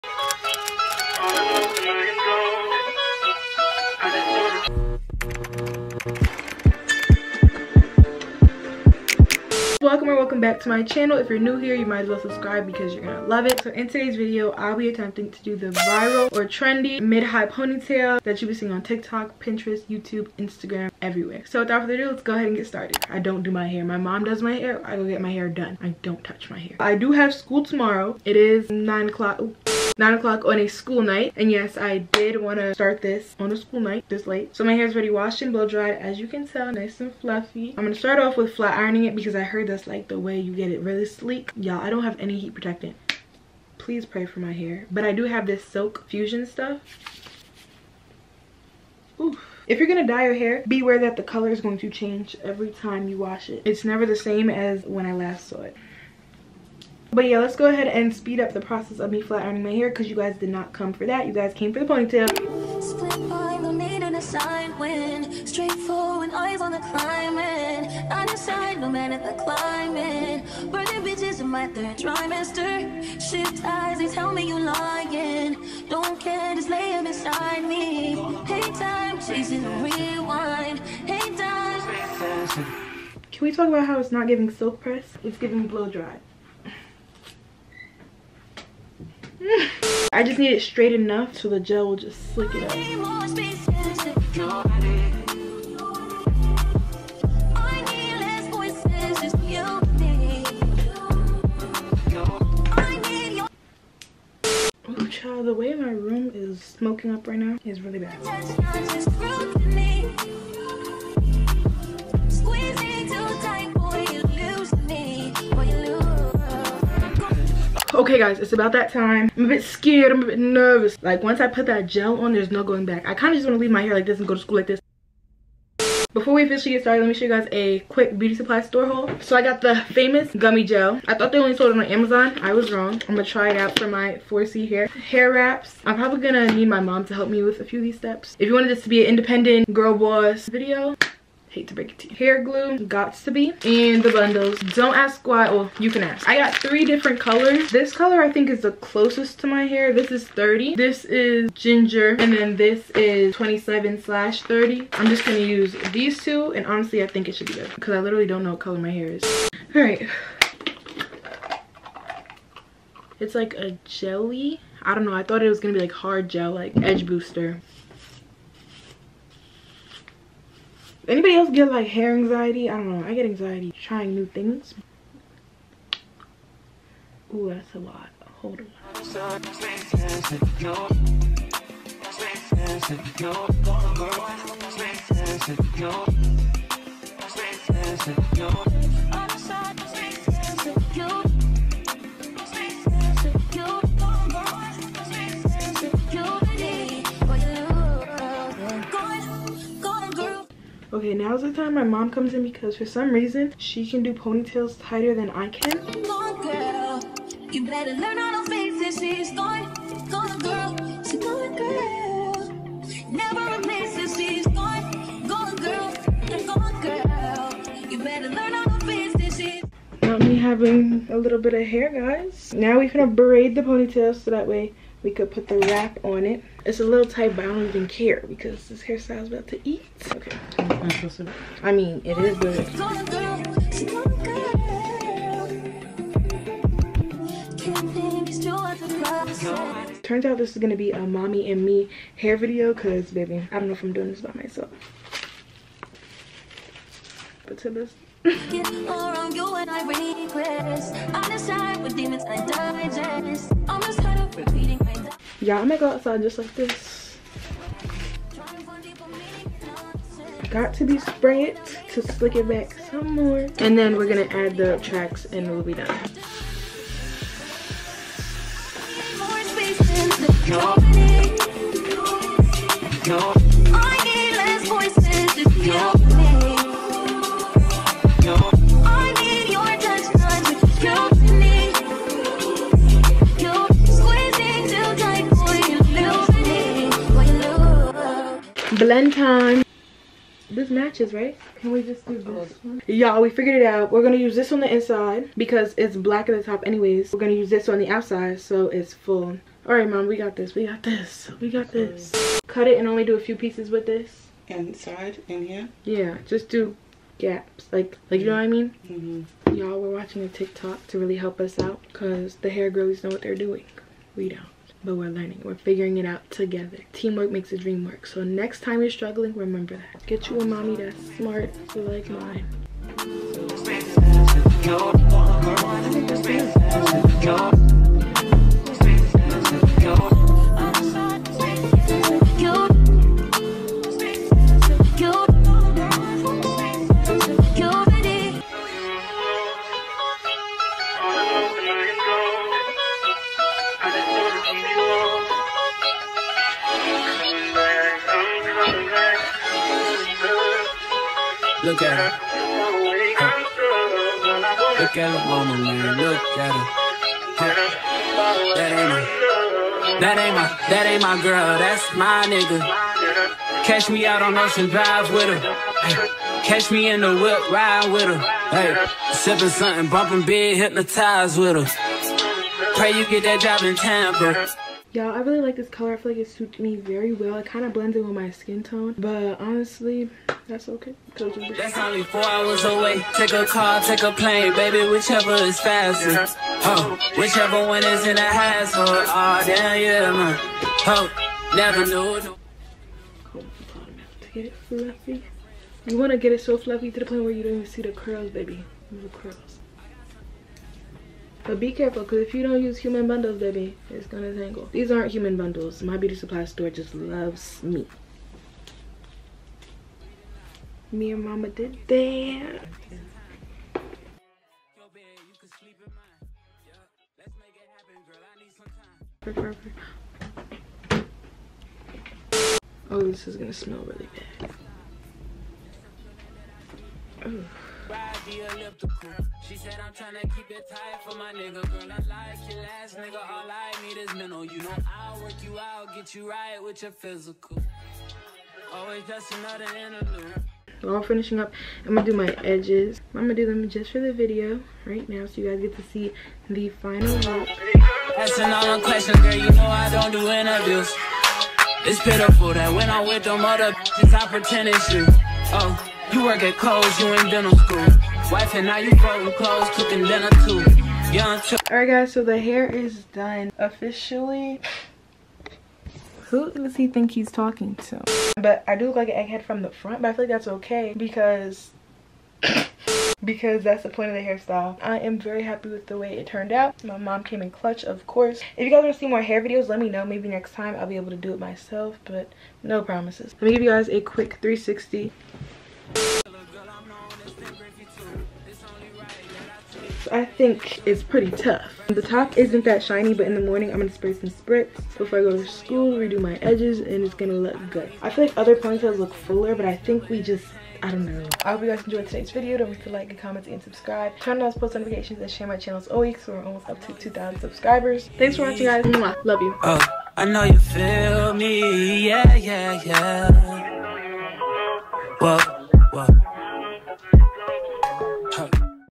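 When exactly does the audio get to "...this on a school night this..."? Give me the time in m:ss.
0:33.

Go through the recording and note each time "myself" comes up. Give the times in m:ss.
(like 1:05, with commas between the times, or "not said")
4:04, 8:01.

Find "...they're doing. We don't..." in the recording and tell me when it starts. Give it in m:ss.
5:13.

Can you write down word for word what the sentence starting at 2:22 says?
Hair glue, Got2b, and the bundles.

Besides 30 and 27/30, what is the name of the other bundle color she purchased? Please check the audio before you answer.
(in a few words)
ginger.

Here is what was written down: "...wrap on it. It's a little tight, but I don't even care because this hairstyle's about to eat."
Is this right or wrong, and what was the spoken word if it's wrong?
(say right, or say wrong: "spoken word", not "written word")
right.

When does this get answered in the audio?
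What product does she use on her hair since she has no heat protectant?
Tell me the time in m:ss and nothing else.
0:45.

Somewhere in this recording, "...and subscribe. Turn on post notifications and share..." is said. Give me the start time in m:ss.
8:23.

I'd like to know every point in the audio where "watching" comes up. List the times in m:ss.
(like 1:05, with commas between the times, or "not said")
5:10, 8:28.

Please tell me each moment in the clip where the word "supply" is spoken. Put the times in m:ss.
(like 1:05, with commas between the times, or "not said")
2:08, 6:46.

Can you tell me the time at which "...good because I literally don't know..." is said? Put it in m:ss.
2:37.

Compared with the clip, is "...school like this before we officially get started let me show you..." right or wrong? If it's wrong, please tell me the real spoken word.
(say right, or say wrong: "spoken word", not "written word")
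right.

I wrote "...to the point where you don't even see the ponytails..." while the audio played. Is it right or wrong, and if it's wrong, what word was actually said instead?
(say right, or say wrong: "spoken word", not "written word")
wrong: "curls", not "ponytails".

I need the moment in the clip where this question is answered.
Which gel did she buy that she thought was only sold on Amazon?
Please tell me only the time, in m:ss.
2:10.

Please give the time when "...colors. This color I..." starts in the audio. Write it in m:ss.
2:27.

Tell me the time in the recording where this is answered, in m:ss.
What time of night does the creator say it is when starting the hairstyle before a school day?
0:30.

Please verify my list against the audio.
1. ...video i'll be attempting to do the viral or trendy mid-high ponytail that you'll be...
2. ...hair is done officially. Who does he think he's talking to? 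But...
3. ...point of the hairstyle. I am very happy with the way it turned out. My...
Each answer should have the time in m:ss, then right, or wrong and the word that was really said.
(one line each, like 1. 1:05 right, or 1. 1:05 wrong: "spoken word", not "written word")
1. 0:14 right
2. 7:42 right
3. 7:53 right.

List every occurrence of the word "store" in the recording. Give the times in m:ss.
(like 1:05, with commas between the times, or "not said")
2:08, 6:46.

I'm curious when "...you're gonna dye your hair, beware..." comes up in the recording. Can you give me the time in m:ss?
0:49.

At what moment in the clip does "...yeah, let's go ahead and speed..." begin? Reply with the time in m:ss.
0:57.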